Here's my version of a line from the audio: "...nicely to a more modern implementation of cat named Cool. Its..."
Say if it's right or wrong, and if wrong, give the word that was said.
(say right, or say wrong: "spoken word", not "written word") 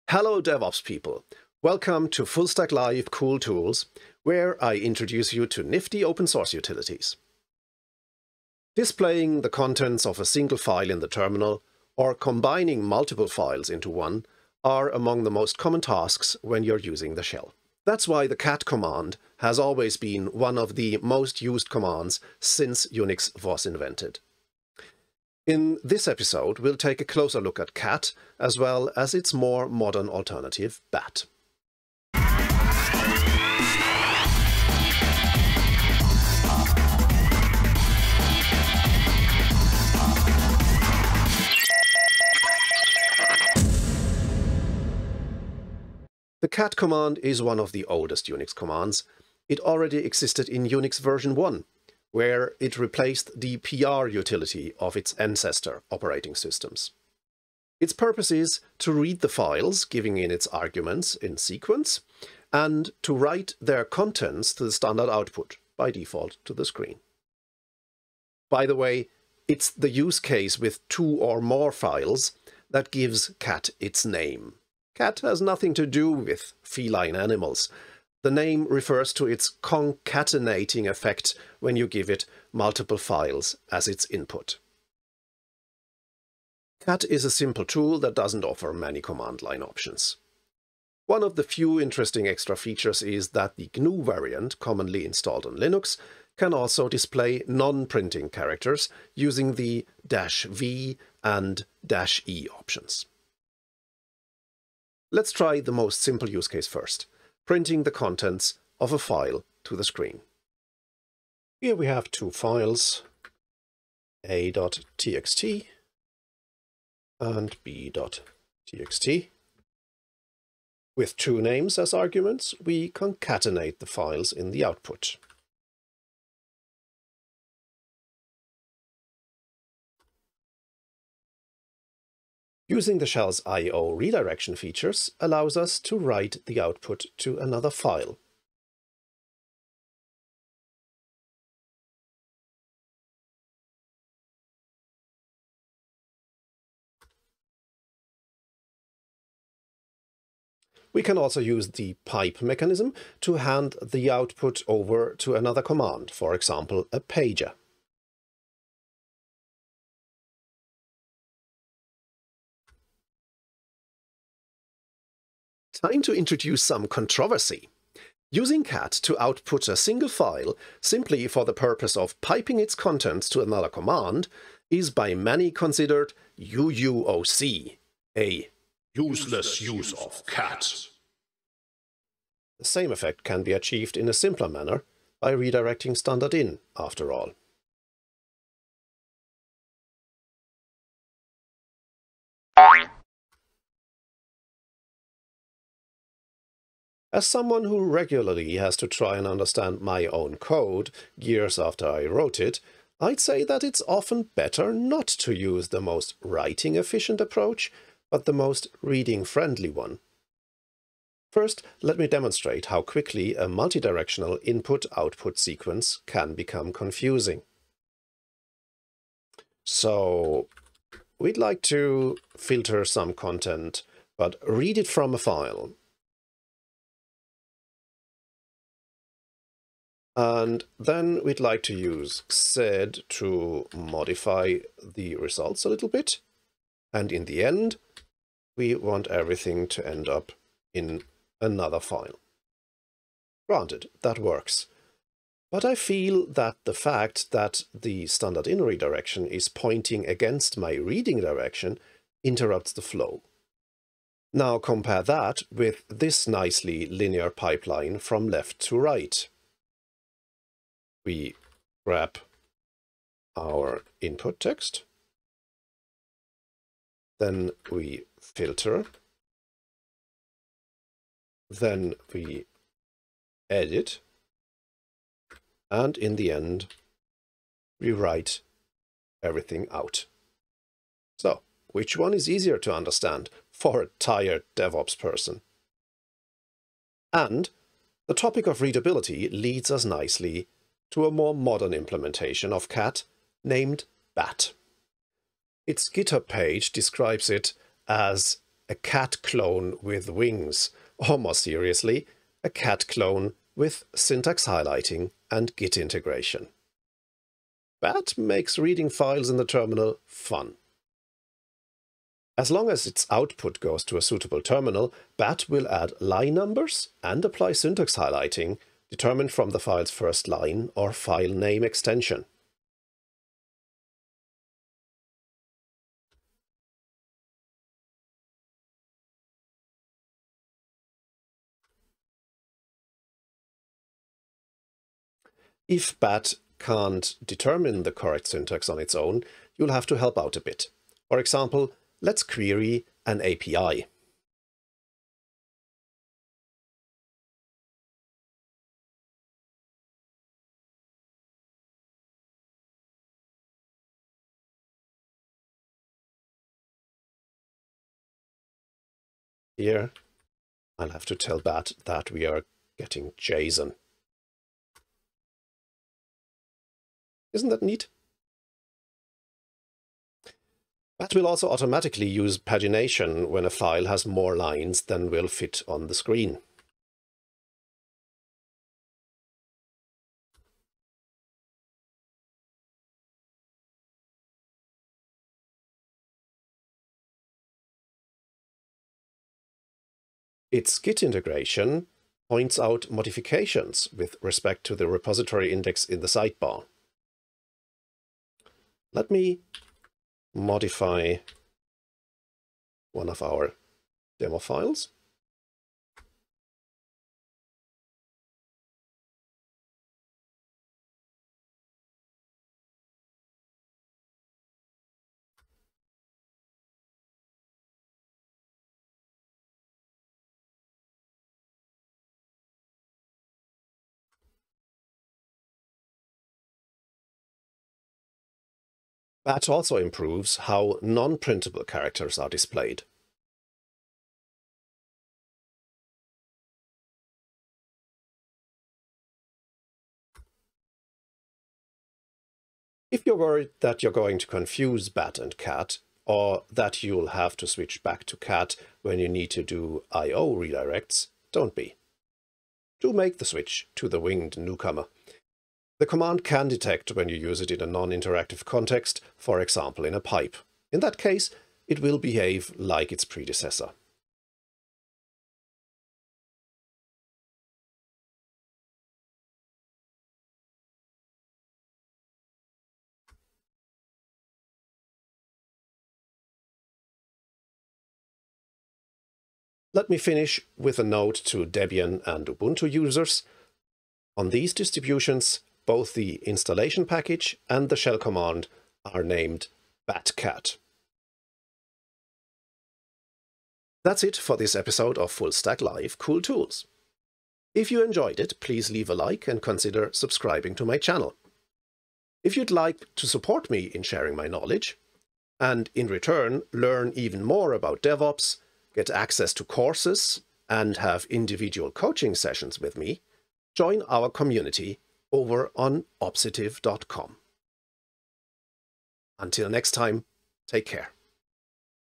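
wrong: "Bat", not "Cool".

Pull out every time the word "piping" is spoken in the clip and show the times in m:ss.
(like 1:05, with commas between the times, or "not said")
2:52.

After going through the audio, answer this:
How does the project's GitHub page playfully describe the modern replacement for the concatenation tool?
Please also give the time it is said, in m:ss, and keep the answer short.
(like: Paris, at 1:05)
a cat clone with wings, at 4:58.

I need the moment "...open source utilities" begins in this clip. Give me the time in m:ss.
0:06.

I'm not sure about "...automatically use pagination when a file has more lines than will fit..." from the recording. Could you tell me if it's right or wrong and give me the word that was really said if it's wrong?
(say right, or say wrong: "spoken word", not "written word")
right.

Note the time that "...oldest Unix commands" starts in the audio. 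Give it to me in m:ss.
0:47.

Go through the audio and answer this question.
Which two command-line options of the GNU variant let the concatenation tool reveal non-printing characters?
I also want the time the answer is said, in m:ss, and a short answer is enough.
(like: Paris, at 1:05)
V and E, at 1:40.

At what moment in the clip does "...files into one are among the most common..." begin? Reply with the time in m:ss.
0:13.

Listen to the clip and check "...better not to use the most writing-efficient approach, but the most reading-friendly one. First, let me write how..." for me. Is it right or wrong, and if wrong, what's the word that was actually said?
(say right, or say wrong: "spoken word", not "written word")
wrong: "demonstrate", not "write".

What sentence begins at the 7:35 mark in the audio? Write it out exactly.
The command can detect when you use it in a non-interactive context, for example in a pipe.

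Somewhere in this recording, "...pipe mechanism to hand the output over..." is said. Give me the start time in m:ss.
2:32.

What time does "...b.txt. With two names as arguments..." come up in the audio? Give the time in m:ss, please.
1:57.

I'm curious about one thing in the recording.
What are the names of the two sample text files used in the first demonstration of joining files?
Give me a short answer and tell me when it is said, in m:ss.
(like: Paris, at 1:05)
a.txt and b.txt, at 1:54.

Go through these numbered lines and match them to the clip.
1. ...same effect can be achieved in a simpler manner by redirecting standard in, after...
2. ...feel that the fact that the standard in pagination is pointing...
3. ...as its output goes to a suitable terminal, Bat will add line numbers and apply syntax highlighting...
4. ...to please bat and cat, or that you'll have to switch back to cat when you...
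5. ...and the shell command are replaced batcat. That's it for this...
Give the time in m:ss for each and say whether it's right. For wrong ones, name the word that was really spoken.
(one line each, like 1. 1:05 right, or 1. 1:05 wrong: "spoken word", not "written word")
1. 3:02 right
2. 4:05 wrong: "redirection", not "pagination"
3. 5:12 right
4. 7:24 wrong: "confuse", not "please"
5. 8:07 wrong: "named", not "replaced".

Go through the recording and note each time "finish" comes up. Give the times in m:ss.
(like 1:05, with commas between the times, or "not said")
7:59.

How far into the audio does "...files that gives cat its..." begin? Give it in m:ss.
1:11.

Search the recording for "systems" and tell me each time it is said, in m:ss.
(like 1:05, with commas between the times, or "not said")
0:56.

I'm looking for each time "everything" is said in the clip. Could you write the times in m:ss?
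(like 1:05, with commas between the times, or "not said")
3:59, 4:39.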